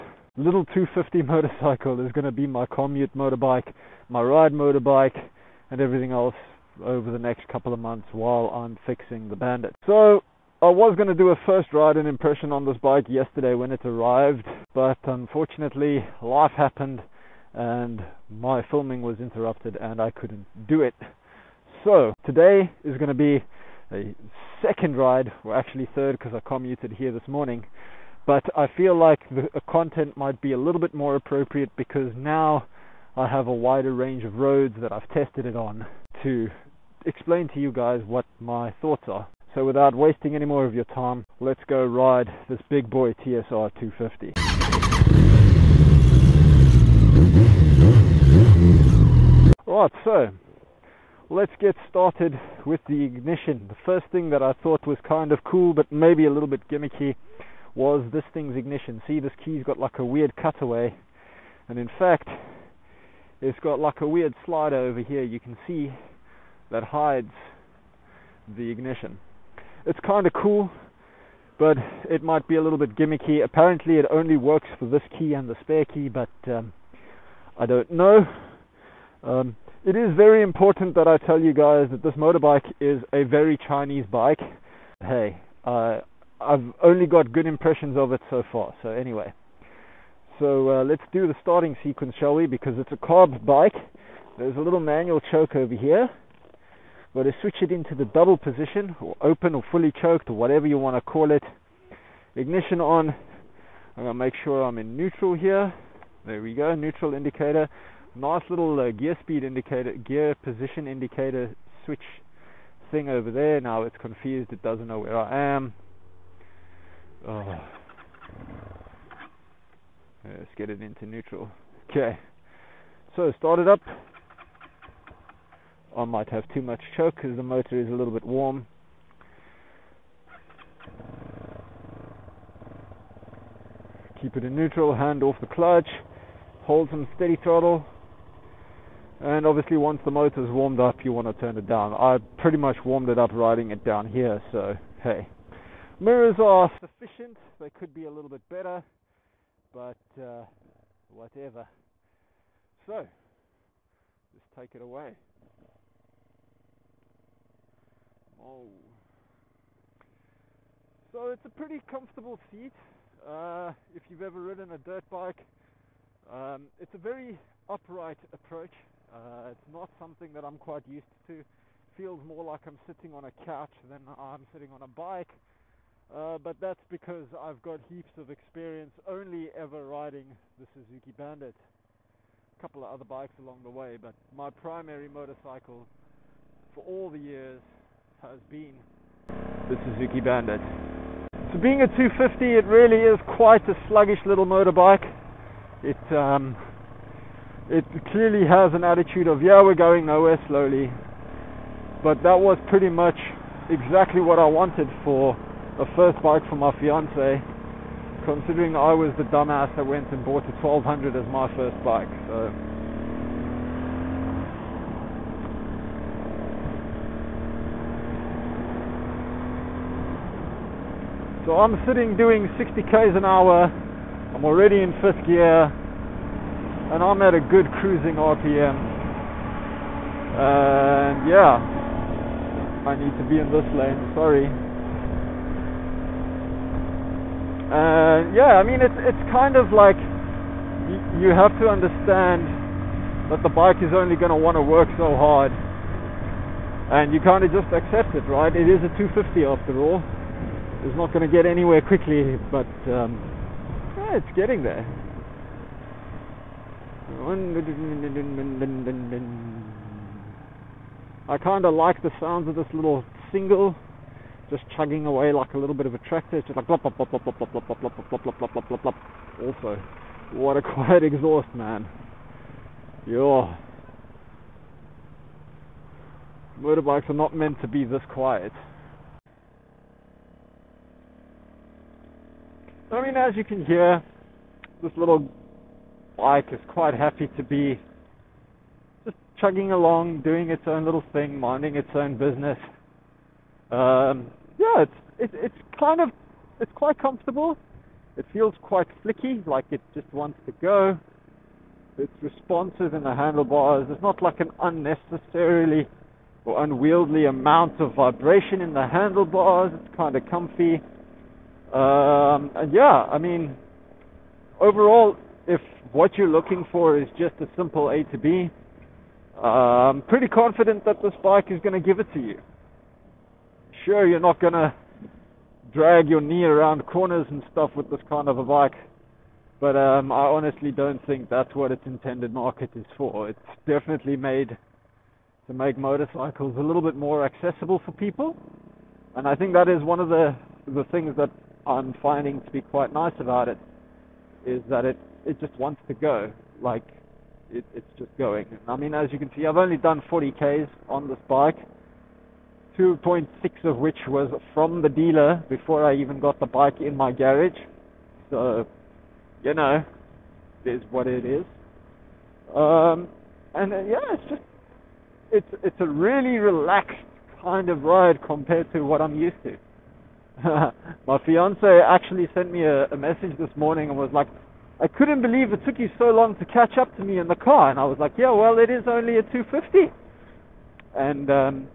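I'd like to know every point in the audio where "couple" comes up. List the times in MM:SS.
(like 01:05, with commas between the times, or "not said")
00:07, 03:02.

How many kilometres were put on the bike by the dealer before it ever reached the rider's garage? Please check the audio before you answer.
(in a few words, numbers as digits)
2.6.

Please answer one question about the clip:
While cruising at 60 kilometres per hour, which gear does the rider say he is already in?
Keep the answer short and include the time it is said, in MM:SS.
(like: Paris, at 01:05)
fifth gear, at 03:45.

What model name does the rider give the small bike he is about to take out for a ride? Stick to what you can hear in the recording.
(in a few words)
TSR 250.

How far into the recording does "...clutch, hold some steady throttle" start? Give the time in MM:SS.
02:15.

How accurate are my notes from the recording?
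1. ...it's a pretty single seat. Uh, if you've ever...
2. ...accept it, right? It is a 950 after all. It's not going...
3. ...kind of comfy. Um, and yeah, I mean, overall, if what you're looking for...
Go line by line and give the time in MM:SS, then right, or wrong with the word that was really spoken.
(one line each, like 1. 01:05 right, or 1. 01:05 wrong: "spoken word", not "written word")
1. 02:41 wrong: "comfortable", not "single"
2. 04:07 wrong: "250", not "950"
3. 05:09 right.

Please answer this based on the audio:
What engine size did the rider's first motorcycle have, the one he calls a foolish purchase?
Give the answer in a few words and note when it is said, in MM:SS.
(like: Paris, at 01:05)
1200, at 03:30.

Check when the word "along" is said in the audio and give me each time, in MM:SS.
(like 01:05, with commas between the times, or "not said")
03:03, 04:49.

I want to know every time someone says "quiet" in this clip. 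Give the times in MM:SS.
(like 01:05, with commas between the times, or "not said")
04:30, 04:38.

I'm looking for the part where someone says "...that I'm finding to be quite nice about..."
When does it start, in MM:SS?
05:41.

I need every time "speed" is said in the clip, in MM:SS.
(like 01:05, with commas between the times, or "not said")
01:49.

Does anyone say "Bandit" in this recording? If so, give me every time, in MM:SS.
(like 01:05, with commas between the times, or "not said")
00:09, 03:01, 03:10.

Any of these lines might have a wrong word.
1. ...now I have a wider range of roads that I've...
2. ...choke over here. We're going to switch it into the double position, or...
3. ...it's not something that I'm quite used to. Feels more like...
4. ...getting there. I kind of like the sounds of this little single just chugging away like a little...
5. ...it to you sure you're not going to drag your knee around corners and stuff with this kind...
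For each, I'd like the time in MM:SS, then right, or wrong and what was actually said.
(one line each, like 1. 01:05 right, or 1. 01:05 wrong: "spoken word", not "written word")
1. 00:32 right
2. 01:35 right
3. 02:49 right
4. 04:14 right
5. 05:22 right.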